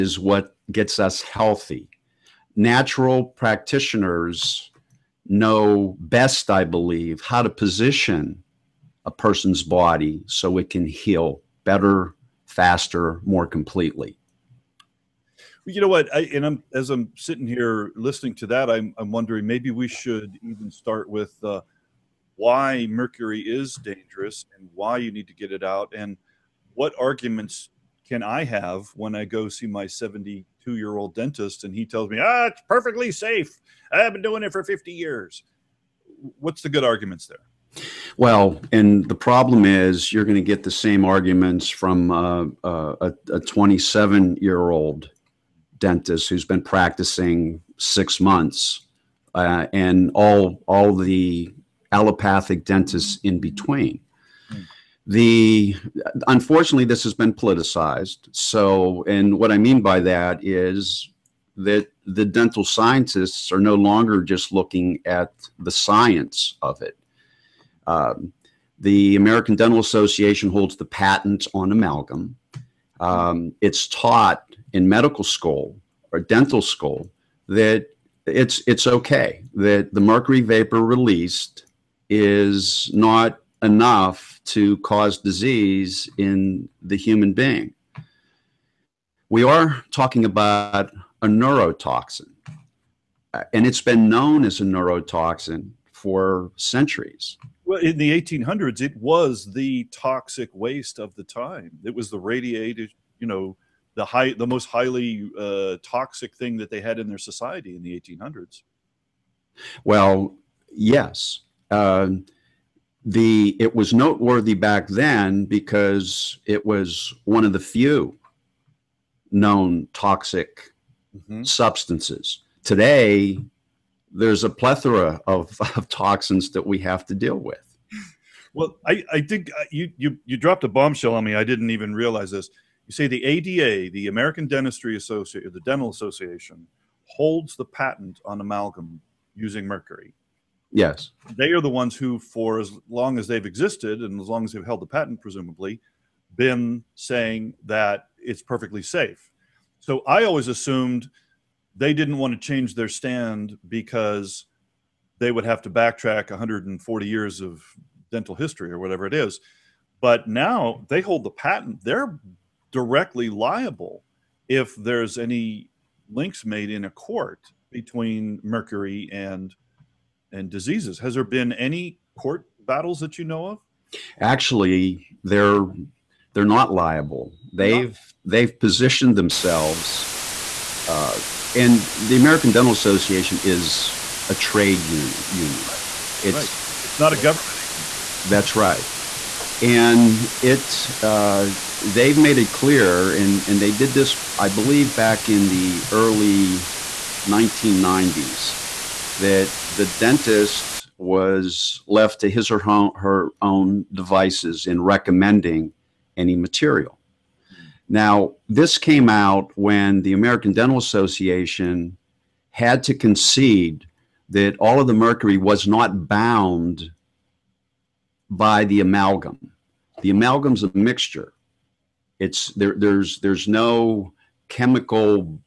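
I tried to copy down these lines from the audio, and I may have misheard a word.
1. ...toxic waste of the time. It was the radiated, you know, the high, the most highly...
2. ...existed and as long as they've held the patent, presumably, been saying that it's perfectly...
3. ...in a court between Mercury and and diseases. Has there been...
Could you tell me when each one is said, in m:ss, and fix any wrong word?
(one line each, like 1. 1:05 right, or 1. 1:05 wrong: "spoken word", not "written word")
1. 1:39 right
2. 2:23 right
3. 2:46 right.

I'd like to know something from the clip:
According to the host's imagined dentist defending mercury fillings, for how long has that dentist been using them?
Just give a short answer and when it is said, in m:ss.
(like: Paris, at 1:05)
50 years, at 0:34.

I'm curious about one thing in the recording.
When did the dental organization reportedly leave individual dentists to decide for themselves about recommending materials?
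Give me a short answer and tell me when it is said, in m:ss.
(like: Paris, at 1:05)
early 1990s, at 3:15.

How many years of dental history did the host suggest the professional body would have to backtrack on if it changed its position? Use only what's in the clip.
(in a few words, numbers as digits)
140 years.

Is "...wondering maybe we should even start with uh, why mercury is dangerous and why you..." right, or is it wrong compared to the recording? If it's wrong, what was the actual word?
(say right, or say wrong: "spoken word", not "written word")
right.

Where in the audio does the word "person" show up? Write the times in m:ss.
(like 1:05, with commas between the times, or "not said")
0:09.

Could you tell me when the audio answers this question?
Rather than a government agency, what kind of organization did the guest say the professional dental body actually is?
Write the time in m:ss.
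3:04.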